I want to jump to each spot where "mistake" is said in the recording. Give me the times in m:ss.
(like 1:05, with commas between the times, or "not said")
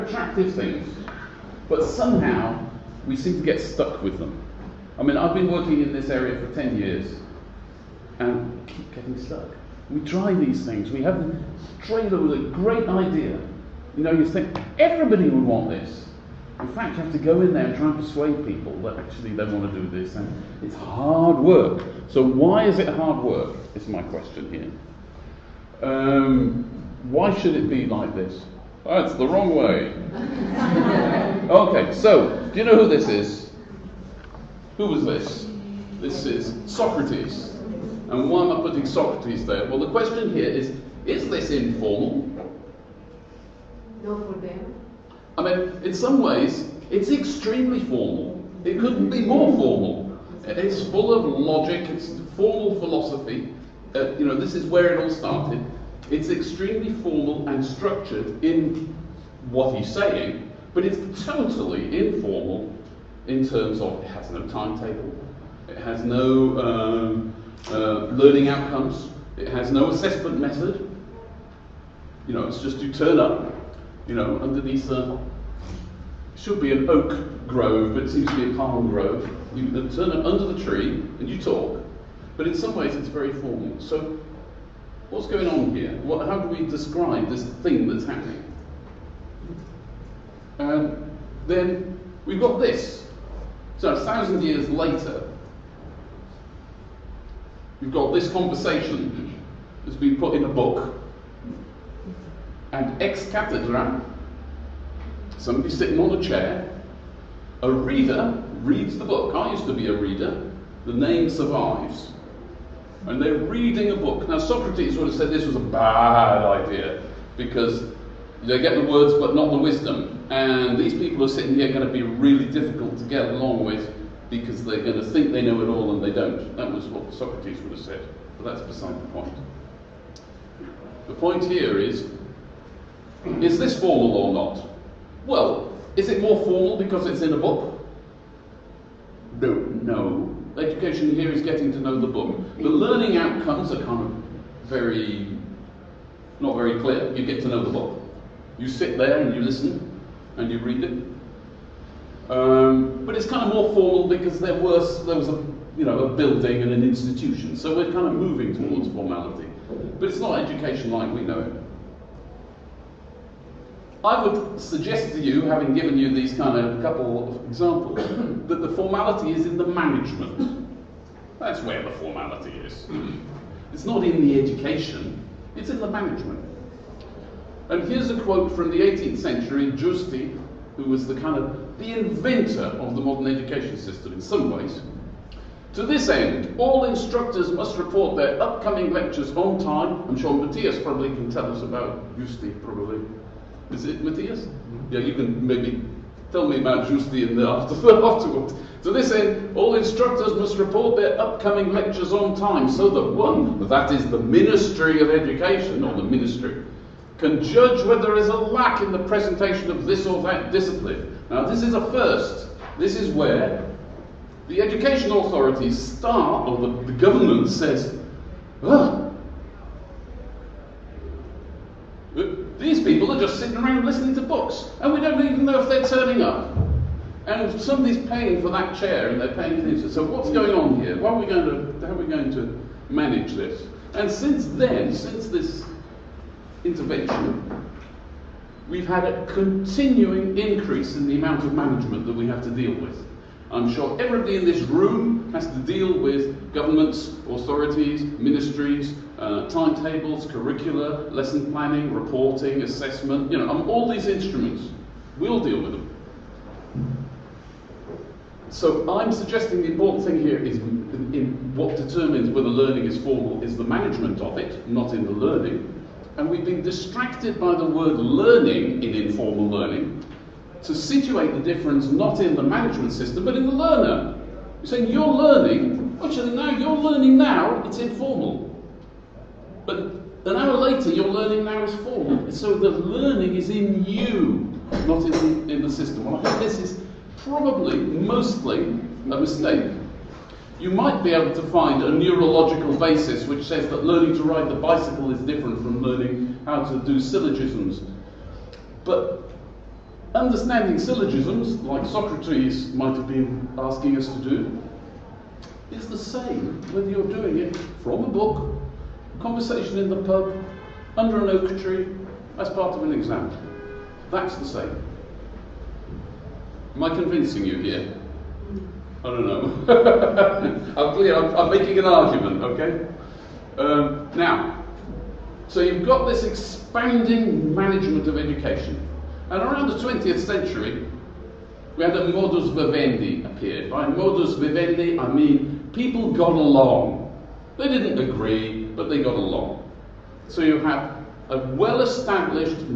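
4:49.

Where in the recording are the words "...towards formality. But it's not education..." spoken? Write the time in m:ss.
2:38.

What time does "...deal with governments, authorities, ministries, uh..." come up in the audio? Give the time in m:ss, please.
4:05.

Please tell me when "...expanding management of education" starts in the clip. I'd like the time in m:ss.
5:26.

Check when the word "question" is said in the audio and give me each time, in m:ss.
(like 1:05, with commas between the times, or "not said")
0:24, 0:39.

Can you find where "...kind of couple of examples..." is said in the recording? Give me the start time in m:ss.
2:46.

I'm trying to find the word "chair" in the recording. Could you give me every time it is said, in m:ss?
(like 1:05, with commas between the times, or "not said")
1:46, 3:48.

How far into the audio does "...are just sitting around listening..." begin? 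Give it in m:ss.
3:43.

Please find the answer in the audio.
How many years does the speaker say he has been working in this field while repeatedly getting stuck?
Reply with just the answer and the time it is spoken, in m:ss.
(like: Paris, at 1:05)
10, at 0:06.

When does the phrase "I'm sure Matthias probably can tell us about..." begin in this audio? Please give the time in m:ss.
3:10.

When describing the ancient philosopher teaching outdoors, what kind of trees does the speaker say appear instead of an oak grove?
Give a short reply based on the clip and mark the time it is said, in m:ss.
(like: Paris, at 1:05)
palm grove, at 1:18.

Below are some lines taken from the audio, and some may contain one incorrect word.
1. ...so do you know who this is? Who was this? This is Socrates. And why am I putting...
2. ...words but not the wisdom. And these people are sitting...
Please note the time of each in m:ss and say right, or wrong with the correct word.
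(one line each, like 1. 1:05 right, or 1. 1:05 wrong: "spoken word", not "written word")
1. 0:31 right
2. 1:58 right.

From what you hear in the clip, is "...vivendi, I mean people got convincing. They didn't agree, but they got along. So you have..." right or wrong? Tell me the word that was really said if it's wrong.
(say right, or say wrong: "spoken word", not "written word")
wrong: "along", not "convincing".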